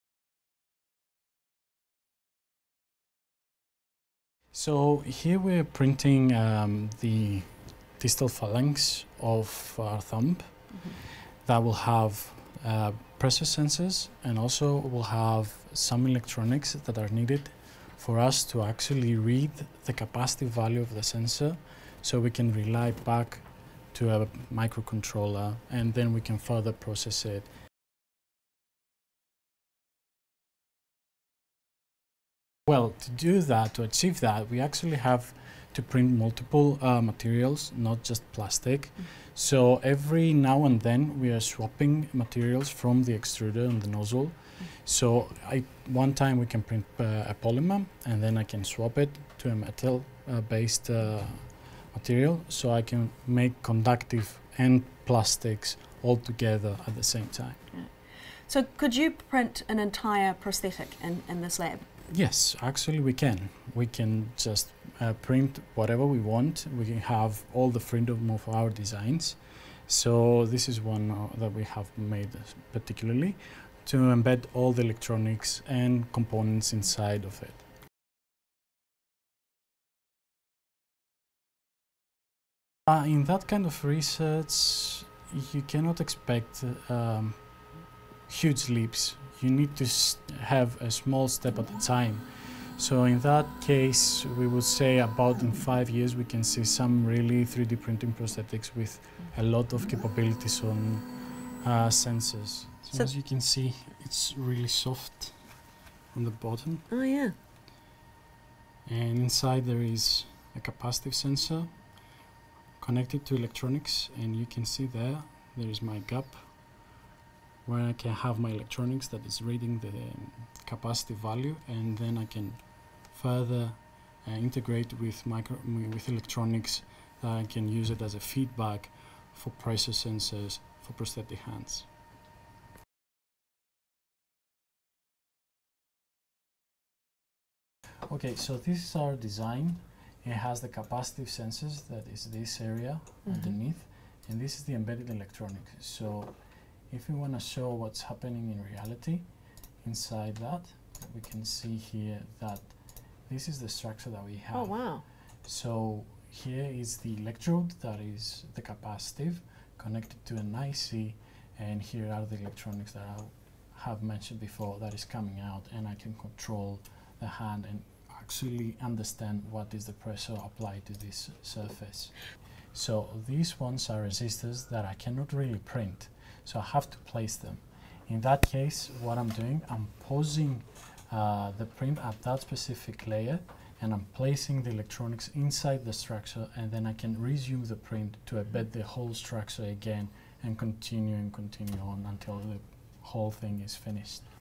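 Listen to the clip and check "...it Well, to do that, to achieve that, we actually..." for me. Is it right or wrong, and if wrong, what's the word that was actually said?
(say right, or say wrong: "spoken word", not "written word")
right.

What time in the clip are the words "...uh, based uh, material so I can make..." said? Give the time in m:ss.
0:50.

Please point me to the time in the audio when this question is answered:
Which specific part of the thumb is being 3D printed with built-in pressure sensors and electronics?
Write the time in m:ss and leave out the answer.
0:07.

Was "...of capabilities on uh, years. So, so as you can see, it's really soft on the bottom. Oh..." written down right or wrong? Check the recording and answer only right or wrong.
wrong.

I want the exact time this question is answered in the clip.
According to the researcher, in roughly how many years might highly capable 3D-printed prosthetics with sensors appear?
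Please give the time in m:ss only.
1:35.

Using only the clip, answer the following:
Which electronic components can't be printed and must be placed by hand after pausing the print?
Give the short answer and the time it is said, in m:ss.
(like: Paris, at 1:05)
Resistors, at 2:54.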